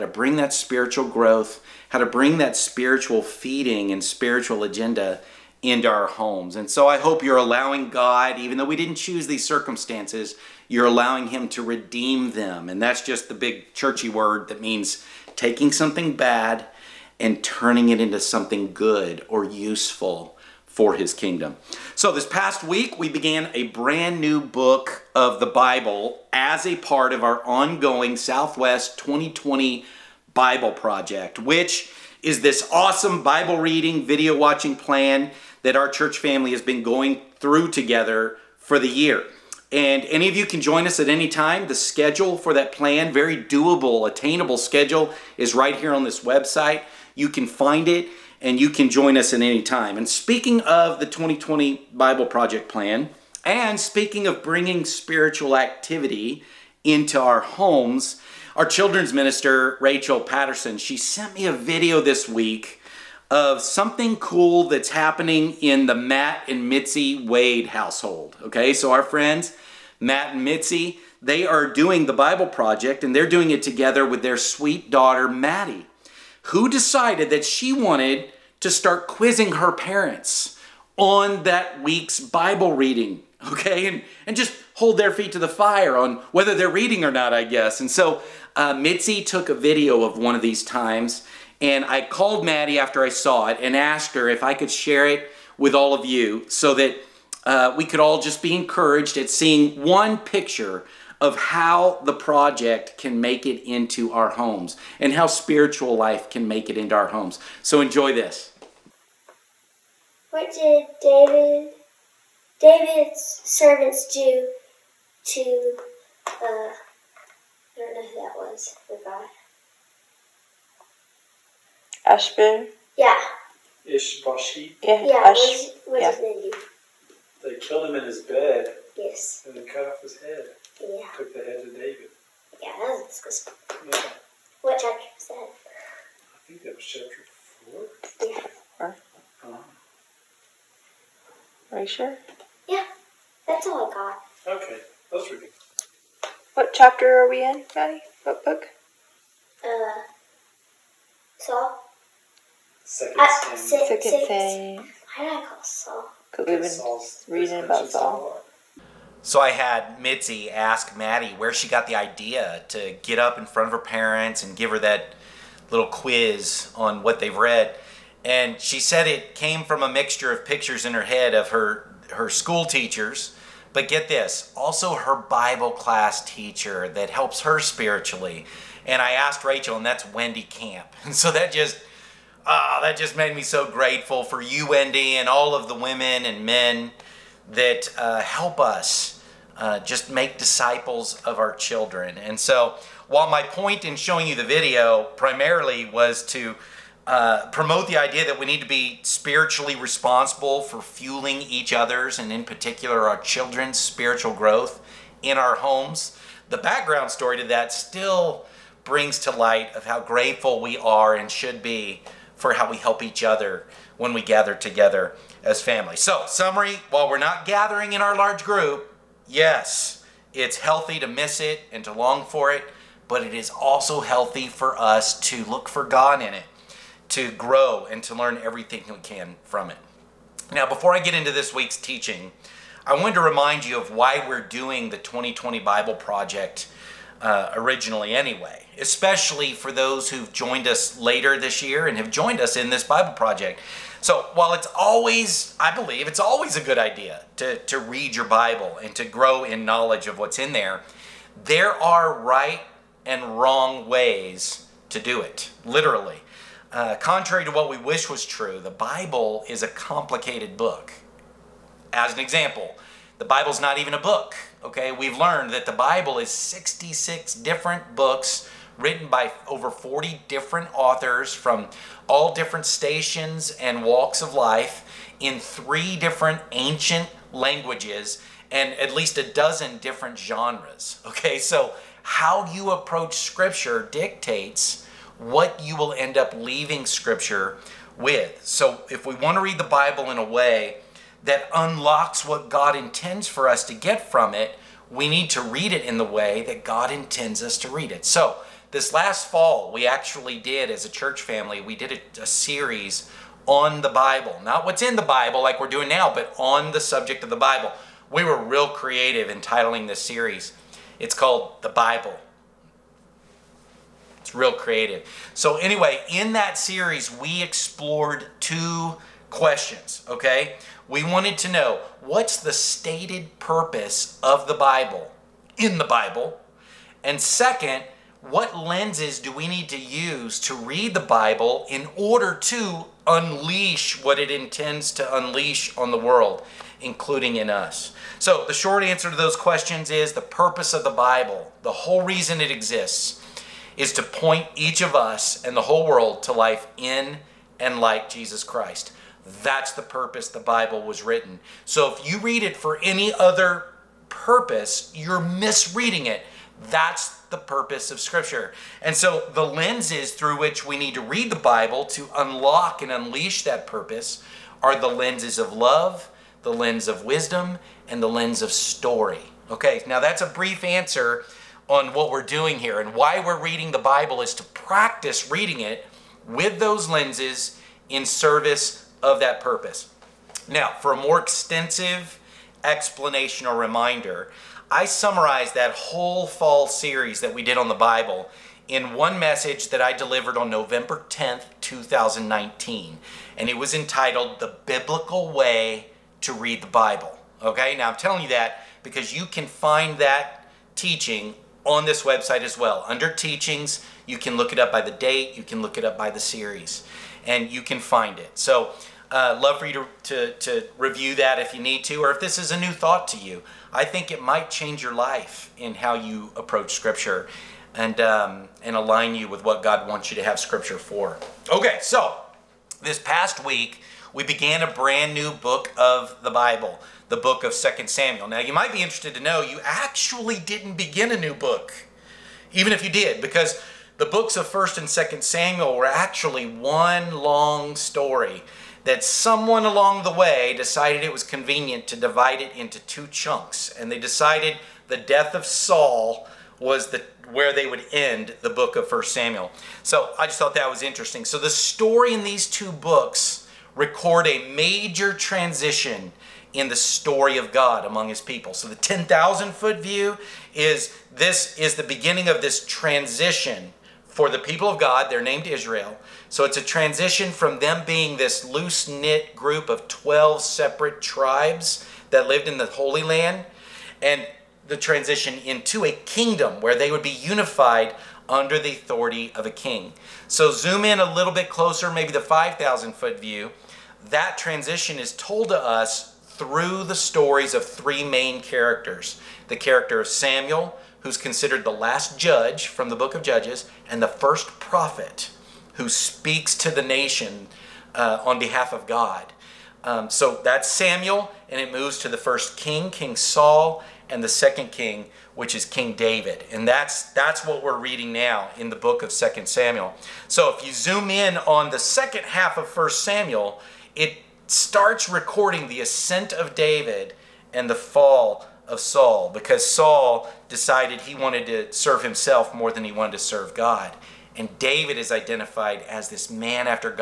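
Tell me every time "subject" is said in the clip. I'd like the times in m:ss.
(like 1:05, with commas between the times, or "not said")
5:06.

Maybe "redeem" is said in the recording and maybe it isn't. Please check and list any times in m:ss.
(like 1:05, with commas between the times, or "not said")
0:11.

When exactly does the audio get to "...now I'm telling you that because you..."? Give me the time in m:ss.
6:37.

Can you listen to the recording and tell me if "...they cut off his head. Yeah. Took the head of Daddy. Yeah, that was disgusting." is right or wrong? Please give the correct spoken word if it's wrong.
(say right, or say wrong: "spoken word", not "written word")
wrong: "David", not "Daddy".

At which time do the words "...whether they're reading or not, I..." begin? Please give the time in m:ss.
1:26.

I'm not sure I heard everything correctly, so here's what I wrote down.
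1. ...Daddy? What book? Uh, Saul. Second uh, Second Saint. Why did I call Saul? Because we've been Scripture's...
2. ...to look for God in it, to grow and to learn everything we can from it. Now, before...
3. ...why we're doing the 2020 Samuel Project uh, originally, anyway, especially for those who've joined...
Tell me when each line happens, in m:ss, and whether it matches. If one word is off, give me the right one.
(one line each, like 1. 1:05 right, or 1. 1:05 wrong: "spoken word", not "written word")
1. 2:27 wrong: "Saul", not "Scripture"
2. 3:45 right
3. 3:53 wrong: "Bible", not "Samuel".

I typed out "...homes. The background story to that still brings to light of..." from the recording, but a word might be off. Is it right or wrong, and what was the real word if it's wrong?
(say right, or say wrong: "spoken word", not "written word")
right.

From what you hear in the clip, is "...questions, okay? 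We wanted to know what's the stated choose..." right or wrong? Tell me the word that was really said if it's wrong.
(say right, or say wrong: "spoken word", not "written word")
wrong: "purpose", not "choose".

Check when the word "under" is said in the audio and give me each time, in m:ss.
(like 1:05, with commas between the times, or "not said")
6:42, 7:58.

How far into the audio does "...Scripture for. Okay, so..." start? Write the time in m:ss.
7:00.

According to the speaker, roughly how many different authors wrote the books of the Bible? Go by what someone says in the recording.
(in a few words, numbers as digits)
over 40.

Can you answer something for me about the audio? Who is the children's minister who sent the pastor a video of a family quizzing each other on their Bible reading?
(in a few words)
Rachel Patterson.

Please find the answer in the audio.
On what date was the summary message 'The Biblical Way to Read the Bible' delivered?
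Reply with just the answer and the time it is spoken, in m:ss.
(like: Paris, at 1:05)
November 10th, 2019, at 6:30.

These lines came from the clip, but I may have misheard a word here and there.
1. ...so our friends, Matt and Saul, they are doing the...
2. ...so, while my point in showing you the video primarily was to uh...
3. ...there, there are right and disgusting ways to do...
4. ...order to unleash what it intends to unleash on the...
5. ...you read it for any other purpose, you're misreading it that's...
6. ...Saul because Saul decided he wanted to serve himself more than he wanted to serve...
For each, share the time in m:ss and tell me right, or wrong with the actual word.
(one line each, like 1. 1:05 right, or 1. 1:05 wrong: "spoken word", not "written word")
1. 1:08 wrong: "Mitzi", not "Saul"
2. 3:12 right
3. 4:10 wrong: "wrong", not "disgusting"
4. 5:31 right
5. 5:52 right
6. 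8:38 right.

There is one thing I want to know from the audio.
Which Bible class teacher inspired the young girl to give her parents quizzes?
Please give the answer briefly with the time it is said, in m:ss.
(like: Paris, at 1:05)
Wendy Camp, at 3:00.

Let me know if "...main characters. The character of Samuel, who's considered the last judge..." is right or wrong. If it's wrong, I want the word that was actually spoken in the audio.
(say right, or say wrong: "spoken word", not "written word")
right.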